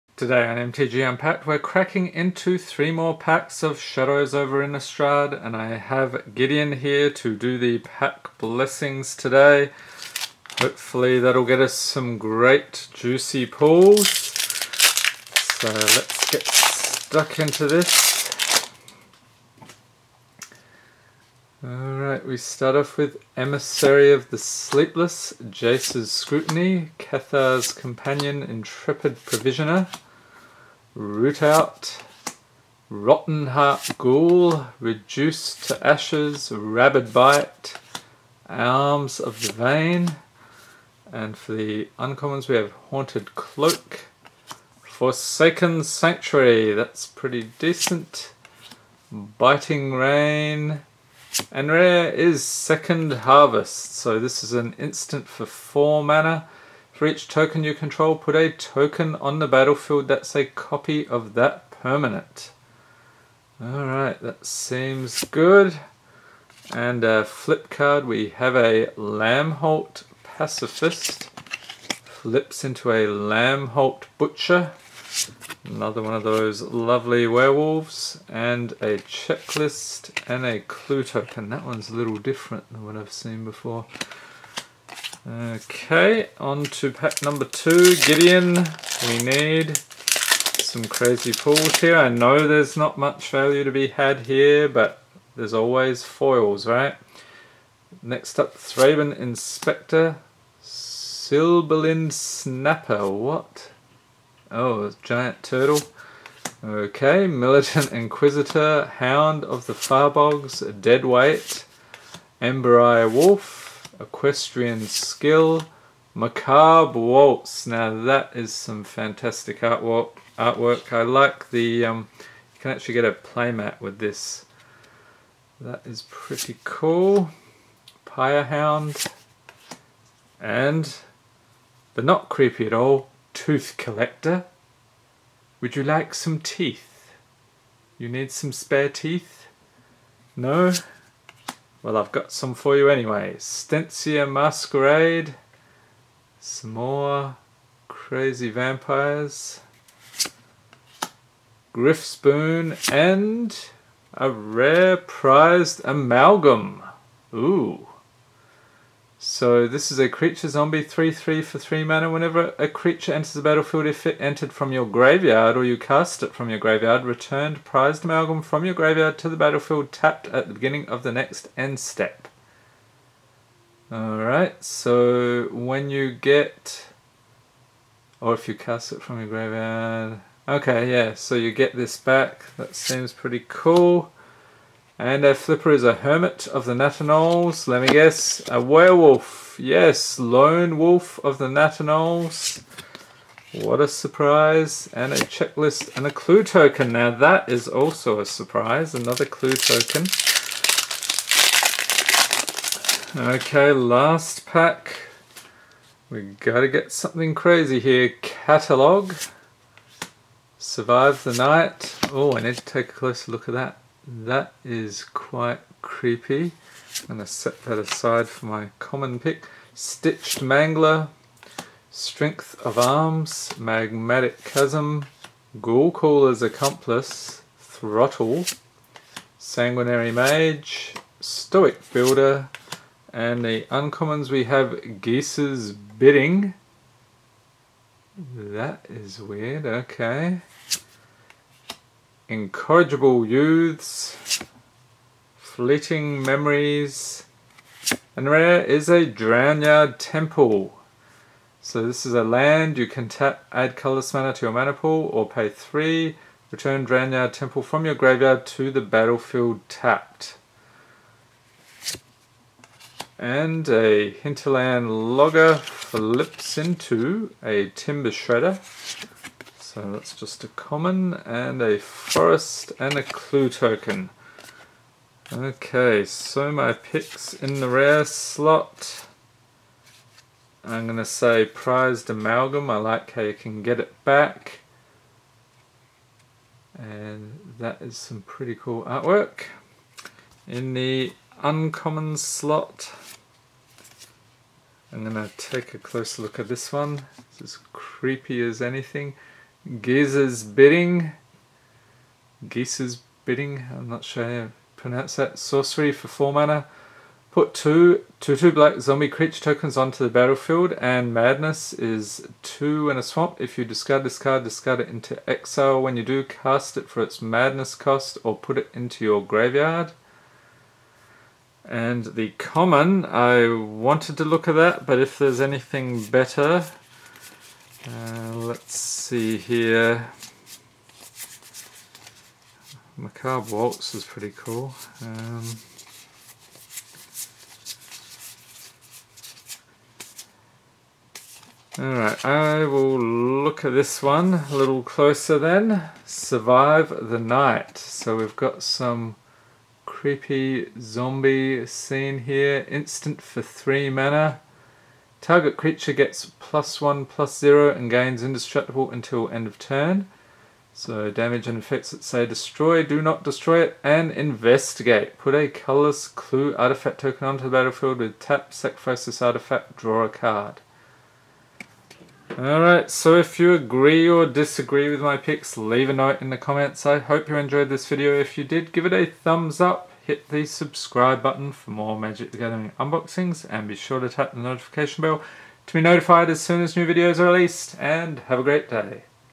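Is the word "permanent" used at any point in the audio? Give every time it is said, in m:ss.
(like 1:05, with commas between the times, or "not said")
1:01.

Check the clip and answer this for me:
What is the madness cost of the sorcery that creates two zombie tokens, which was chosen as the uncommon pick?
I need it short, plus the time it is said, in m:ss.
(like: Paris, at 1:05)
2 and a Swamp, at 5:12.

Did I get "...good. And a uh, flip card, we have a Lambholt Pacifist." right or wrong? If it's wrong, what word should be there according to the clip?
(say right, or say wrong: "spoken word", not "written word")
right.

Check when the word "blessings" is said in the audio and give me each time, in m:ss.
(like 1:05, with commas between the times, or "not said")
0:08.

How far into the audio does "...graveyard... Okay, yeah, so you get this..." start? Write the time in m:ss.
2:59.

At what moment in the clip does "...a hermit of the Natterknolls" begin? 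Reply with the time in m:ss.
3:05.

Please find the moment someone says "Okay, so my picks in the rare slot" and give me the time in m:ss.
4:35.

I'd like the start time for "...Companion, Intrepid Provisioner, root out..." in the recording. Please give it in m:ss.
0:27.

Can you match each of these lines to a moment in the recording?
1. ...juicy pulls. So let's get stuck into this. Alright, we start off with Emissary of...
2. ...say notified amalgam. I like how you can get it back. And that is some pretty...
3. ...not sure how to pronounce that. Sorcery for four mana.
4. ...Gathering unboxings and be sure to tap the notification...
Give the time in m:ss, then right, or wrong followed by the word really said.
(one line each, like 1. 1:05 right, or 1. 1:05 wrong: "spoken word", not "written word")
1. 0:12 right
2. 4:41 wrong: "prized", not "notified"
3. 5:03 right
4. 6:22 right.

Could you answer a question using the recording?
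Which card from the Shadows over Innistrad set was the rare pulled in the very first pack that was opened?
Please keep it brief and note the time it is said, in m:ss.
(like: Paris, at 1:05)
Second Harvest, at 0:52.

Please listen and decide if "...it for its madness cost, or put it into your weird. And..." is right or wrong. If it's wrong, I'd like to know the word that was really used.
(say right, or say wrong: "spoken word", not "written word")
wrong: "graveyard", not "weird".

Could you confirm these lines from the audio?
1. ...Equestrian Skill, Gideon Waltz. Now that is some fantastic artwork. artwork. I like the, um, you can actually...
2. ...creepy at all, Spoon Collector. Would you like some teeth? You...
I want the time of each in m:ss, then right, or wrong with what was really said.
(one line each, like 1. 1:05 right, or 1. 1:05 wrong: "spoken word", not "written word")
1. 1:54 wrong: "Macabre", not "Gideon"
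2. 2:12 wrong: "Tooth", not "Spoon".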